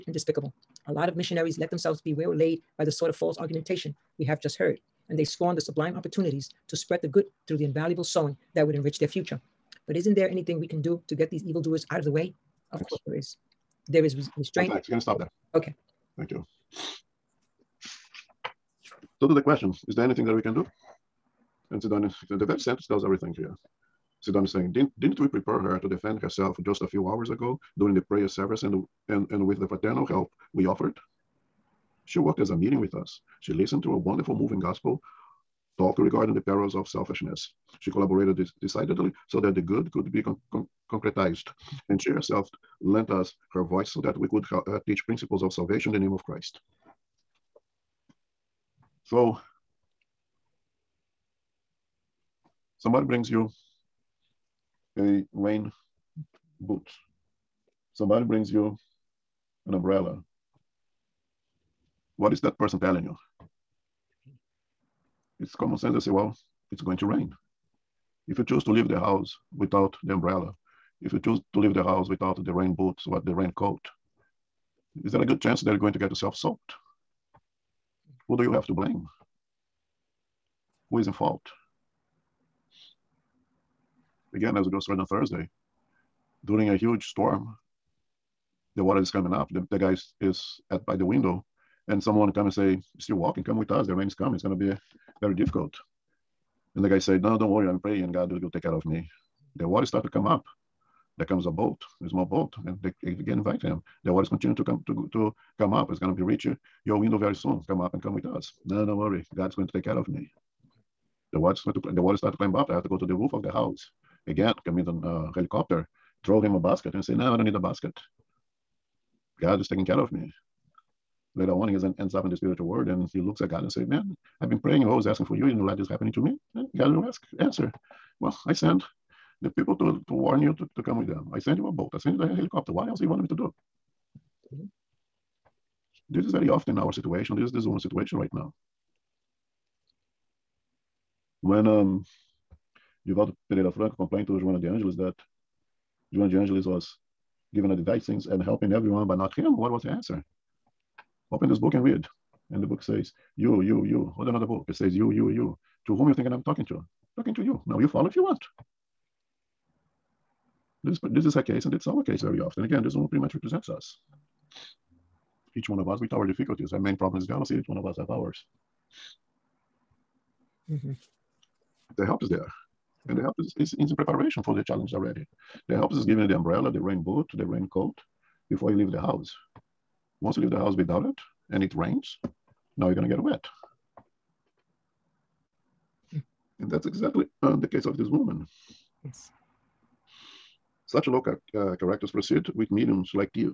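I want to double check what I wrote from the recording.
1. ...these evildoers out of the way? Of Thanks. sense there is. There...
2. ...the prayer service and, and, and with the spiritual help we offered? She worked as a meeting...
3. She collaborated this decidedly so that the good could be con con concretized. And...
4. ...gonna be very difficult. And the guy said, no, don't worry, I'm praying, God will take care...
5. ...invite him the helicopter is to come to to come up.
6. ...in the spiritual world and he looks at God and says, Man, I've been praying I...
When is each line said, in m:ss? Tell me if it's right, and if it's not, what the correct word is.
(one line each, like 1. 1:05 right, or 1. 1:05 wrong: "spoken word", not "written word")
1. 0:11 wrong: "course", not "sense"
2. 0:27 wrong: "fraternal", not "spiritual"
3. 0:37 right
4. 1:34 right
5. 1:43 wrong: "water", not "helicopter"
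6. 2:02 right.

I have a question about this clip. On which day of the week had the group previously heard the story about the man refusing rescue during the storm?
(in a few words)
Thursday.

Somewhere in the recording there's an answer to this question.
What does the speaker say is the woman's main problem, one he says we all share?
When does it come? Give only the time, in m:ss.
2:47.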